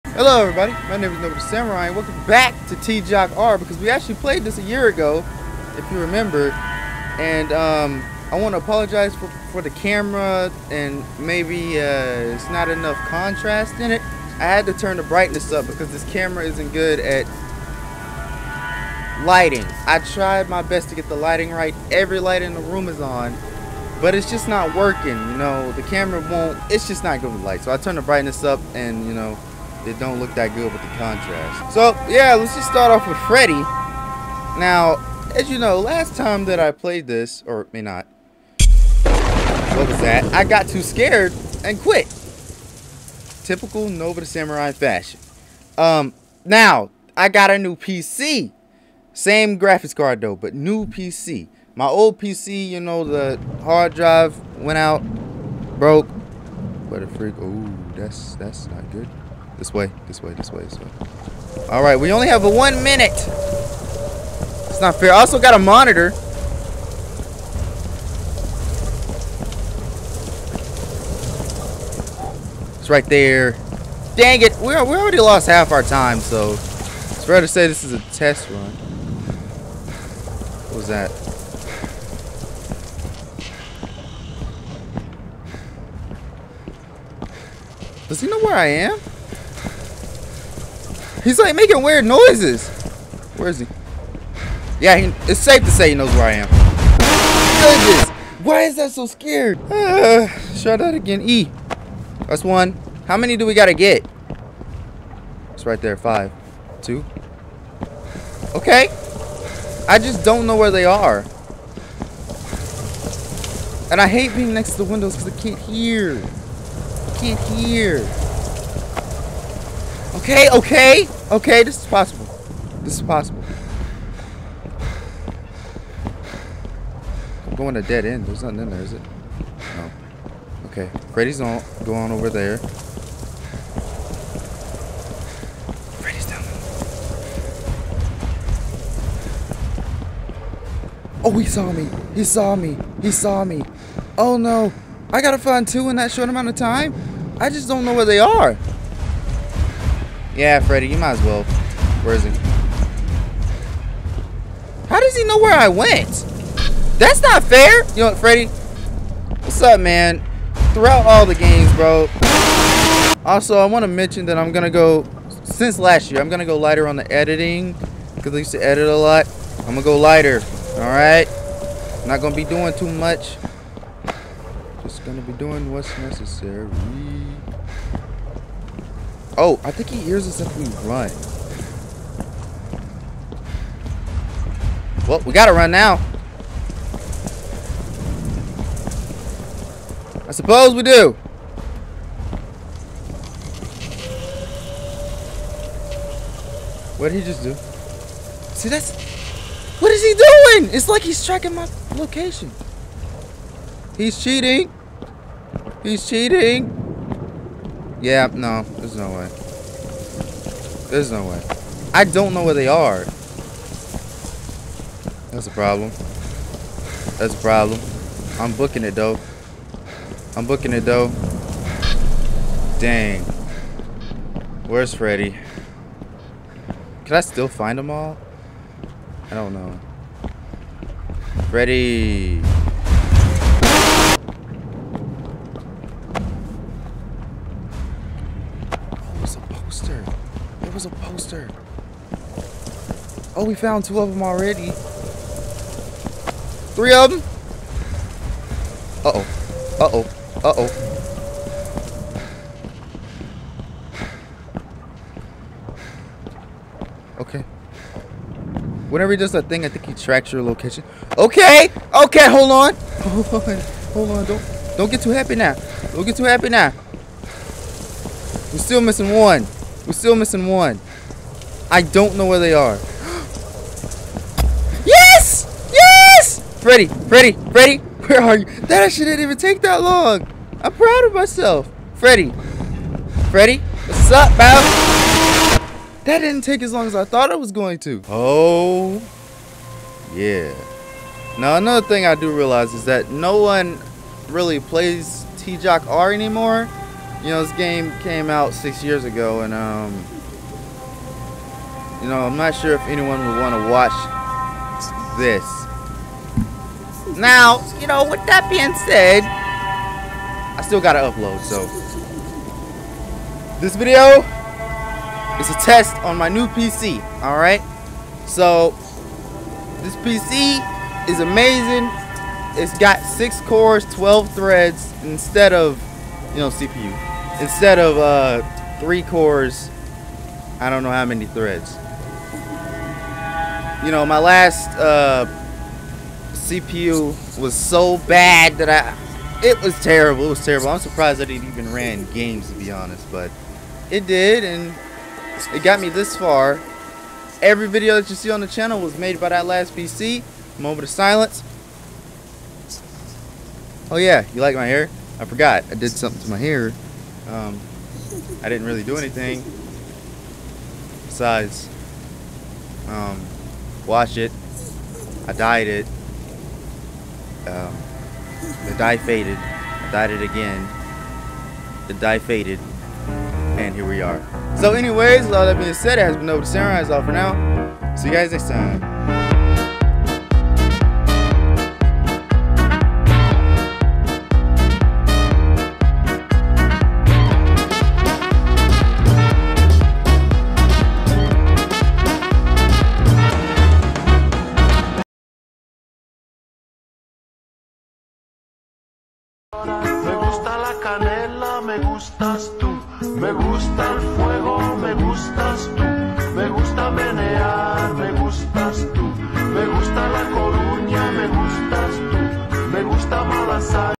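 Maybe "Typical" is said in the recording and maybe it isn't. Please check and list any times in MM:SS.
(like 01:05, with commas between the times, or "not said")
00:43.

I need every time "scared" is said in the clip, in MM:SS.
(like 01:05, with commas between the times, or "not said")
00:40, 01:39.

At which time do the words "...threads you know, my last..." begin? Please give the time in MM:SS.
05:31.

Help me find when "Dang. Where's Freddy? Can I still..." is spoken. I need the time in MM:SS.
03:42.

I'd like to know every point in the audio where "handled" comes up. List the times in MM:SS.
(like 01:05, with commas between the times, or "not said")
not said.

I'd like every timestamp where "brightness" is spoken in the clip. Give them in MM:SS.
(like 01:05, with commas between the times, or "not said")
00:15, 00:28.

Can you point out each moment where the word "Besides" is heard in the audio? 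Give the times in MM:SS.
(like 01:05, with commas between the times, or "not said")
06:01.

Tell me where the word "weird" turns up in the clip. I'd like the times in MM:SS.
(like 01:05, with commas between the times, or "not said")
01:31.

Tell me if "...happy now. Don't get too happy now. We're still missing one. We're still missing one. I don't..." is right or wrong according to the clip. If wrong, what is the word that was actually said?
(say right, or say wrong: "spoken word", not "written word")
right.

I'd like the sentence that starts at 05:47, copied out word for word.
Every video that you see on the channel was made by that last PC.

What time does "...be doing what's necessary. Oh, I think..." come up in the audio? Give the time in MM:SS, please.
02:55.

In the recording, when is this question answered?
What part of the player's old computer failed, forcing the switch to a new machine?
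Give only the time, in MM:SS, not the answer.
00:53.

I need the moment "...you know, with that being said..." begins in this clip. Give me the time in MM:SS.
05:07.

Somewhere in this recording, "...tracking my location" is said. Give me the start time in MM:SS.
03:21.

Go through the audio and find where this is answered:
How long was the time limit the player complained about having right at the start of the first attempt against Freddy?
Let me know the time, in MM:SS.
01:02.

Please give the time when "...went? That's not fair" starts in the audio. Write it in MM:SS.
02:35.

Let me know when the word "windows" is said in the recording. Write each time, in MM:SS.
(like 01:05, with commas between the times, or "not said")
01:54.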